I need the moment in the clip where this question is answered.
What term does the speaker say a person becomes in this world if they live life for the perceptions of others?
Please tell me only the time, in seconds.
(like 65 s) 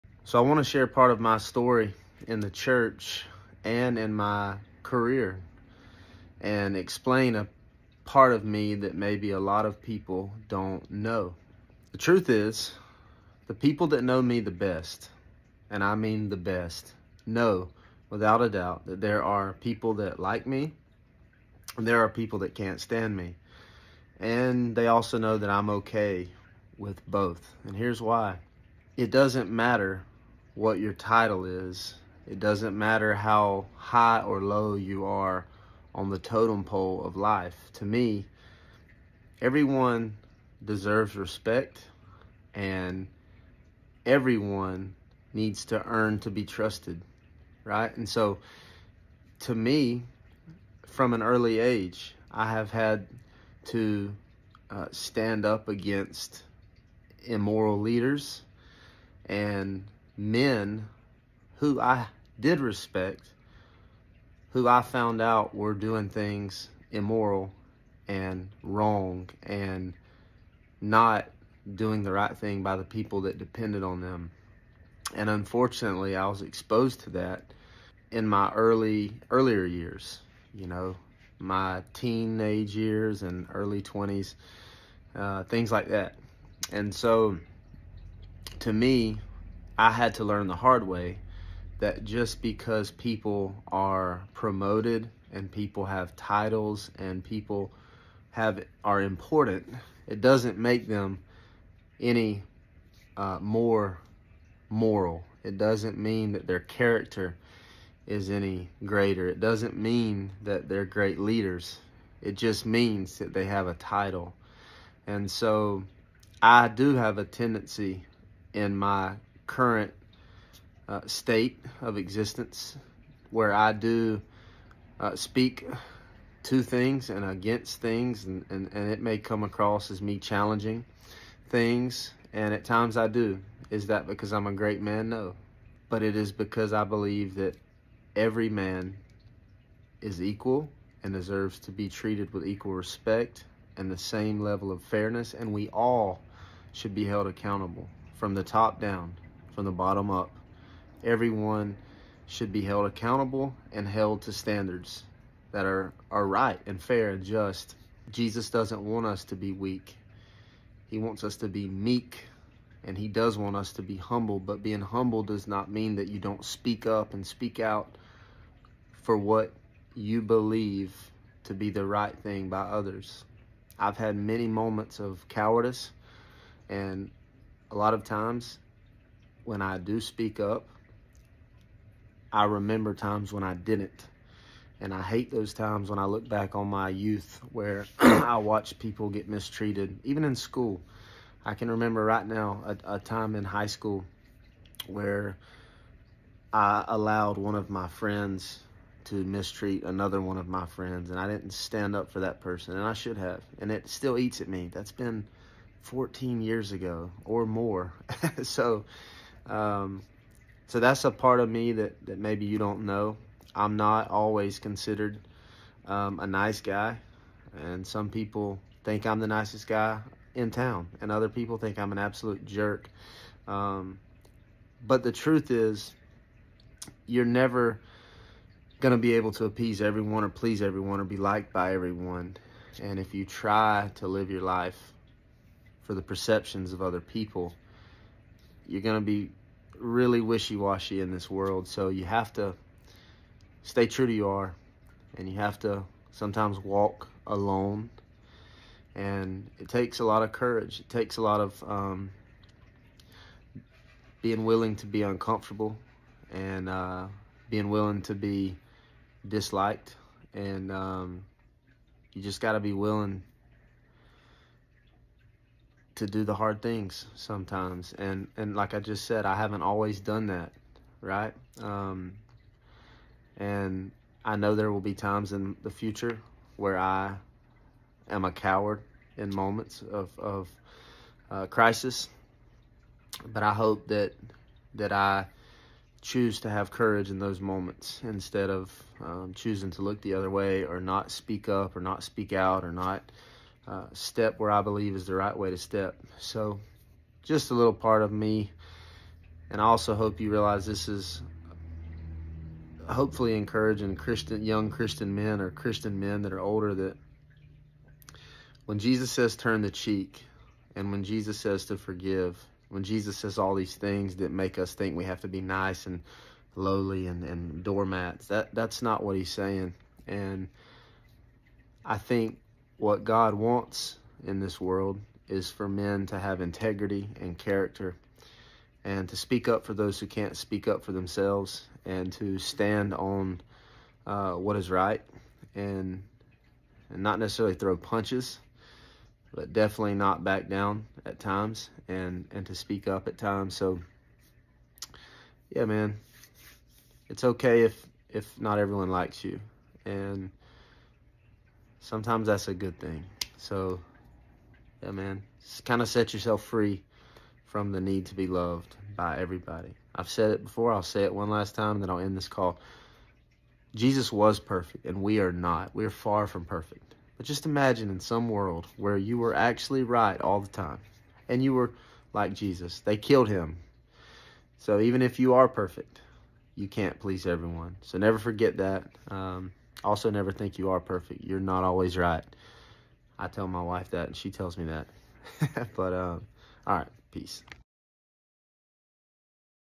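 240 s.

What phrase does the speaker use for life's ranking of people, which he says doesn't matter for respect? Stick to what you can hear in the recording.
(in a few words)
totem pole.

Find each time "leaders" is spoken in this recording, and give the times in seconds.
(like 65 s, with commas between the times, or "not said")
57 s, 111 s.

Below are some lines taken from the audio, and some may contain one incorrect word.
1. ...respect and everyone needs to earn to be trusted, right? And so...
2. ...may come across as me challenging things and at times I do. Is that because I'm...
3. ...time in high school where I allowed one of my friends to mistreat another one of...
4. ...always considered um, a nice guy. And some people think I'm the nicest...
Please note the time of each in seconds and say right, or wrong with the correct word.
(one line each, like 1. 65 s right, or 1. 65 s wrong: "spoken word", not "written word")
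1. 41 s right
2. 129 s right
3. 192 s right
4. 214 s right.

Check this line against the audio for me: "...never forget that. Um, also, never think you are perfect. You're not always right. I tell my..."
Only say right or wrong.
right.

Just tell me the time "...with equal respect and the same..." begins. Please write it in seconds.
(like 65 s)
142 s.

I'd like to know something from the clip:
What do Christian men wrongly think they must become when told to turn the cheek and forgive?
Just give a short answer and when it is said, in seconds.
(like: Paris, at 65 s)
doormats, at 317 s.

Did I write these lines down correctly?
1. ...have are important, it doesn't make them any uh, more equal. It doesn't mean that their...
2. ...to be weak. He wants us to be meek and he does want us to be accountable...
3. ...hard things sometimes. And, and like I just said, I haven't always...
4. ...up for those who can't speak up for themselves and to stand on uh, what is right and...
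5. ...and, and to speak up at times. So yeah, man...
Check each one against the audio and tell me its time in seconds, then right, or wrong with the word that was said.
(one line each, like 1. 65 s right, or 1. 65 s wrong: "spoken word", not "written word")
1. 98 s wrong: "moral", not "equal"
2. 159 s wrong: "humble", not "accountable"
3. 266 s right
4. 329 s right
5. 341 s right.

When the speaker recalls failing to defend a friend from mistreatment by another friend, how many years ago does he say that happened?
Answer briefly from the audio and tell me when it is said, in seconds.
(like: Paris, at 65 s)
14, at 205 s.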